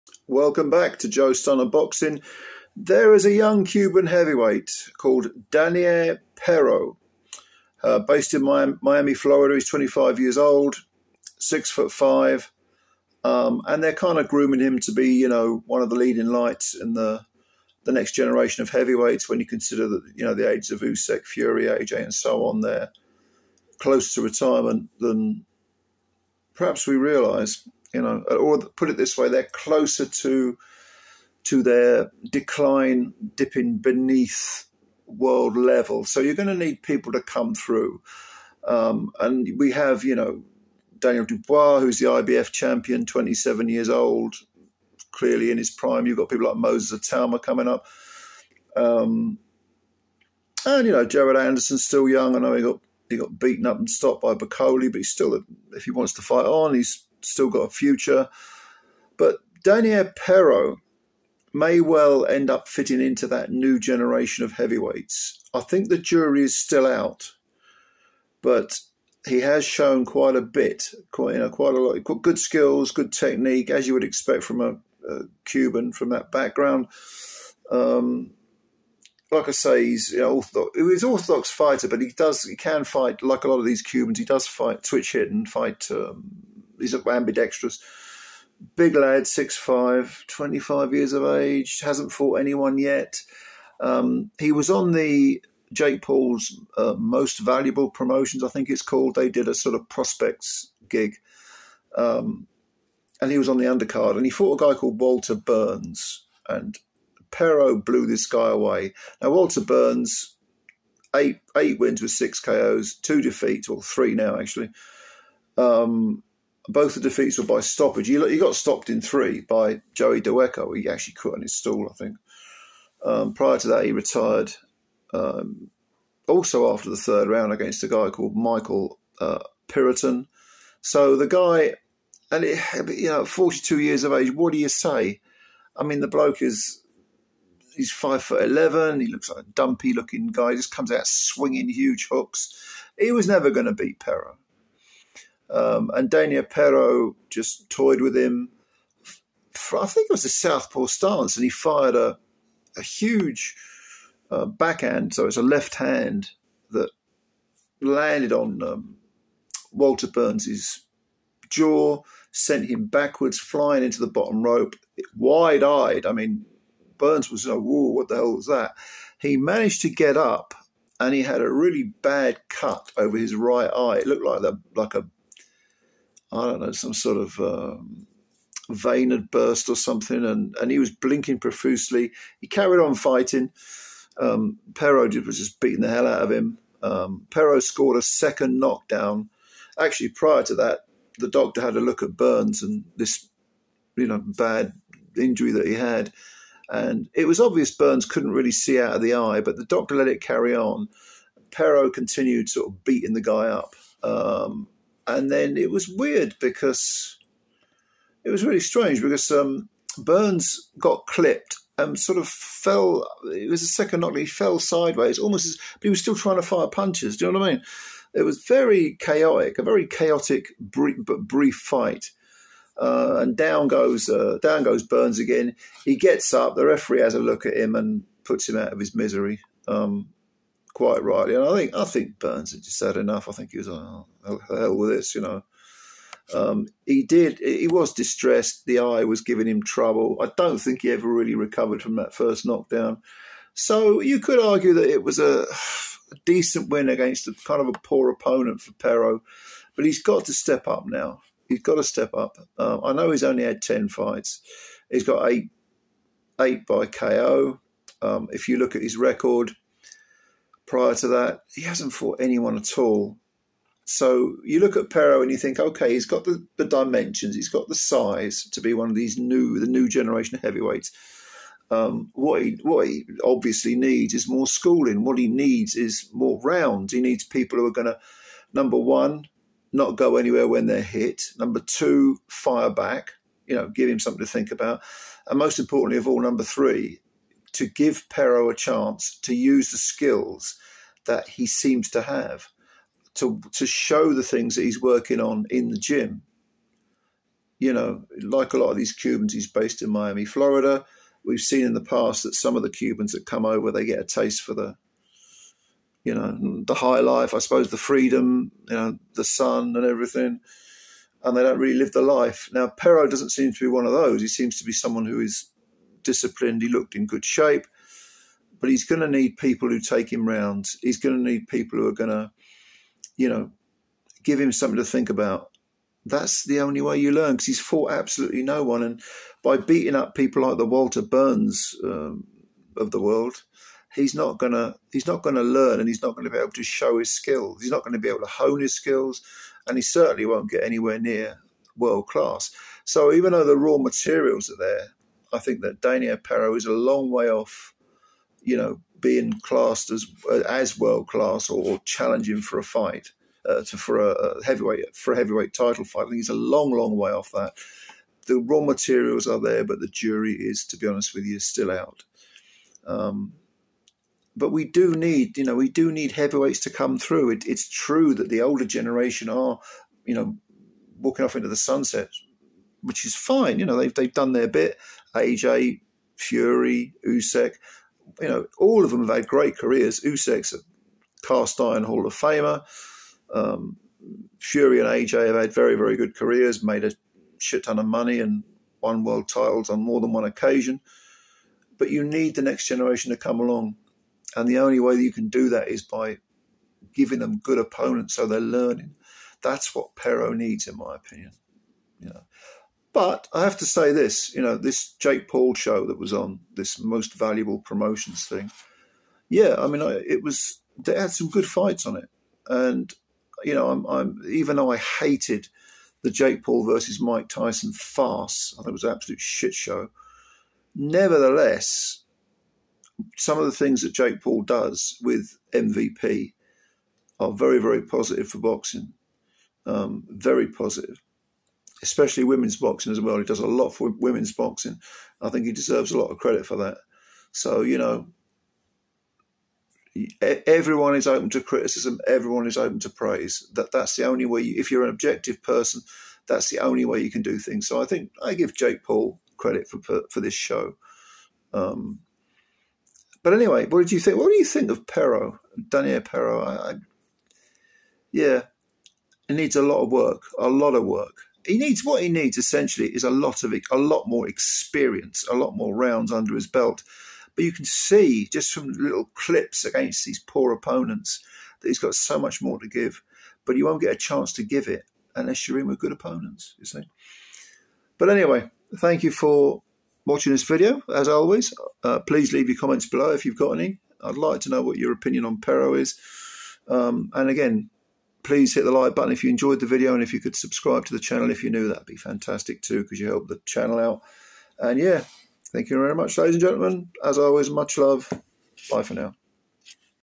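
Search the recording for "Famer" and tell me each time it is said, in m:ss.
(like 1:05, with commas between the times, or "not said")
6:22.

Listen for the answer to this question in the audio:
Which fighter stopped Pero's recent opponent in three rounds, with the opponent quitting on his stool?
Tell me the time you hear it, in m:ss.
1:59.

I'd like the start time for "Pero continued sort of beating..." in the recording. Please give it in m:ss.
3:21.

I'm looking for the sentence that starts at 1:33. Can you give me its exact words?
Um, he was on the Jake Paul's uh, most valuable promotions, I think it's called.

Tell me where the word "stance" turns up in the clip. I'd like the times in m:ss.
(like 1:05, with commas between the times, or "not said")
2:30.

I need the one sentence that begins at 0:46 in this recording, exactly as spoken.
You've got people like Moses Itauma coming up.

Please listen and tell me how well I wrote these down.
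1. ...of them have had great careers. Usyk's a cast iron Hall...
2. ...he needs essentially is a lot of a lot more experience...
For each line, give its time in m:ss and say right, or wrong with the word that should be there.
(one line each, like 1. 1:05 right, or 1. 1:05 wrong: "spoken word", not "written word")
1. 6:18 right
2. 7:42 right.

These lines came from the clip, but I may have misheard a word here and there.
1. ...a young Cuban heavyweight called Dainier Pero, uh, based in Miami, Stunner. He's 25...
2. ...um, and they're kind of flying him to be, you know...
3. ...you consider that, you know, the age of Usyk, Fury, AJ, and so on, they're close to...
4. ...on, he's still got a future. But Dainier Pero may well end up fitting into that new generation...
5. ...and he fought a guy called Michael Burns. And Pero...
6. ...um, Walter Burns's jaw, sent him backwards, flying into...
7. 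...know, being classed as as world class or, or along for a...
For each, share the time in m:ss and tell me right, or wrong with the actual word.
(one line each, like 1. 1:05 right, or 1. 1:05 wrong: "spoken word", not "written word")
1. 0:03 wrong: "Florida", not "Stunner"
2. 0:13 wrong: "grooming", not "flying"
3. 0:19 right
4. 0:56 right
5. 1:44 wrong: "Walter", not "Michael"
6. 2:38 right
7. 5:48 wrong: "challenging", not "along".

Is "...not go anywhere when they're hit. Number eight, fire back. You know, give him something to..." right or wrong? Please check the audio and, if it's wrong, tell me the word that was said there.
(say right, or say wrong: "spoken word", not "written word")
wrong: "two", not "eight".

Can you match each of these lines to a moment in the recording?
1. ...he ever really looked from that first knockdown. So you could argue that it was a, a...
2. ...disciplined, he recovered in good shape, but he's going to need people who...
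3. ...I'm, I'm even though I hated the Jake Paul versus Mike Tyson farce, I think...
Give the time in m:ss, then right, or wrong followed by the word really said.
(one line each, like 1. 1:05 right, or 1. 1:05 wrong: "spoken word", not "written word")
1. 4:00 wrong: "recovered", not "looked"
2. 5:16 wrong: "looked", not "recovered"
3. 6:53 right.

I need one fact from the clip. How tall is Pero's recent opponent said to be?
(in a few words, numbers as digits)
5 foot 11.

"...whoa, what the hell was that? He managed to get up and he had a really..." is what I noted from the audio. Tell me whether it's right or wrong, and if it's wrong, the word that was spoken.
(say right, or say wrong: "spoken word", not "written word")
right.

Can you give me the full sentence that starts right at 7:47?
But you can see just from little clips against these poor opponents that he's got so much more to give.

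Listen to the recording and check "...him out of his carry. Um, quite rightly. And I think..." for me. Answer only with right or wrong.
wrong.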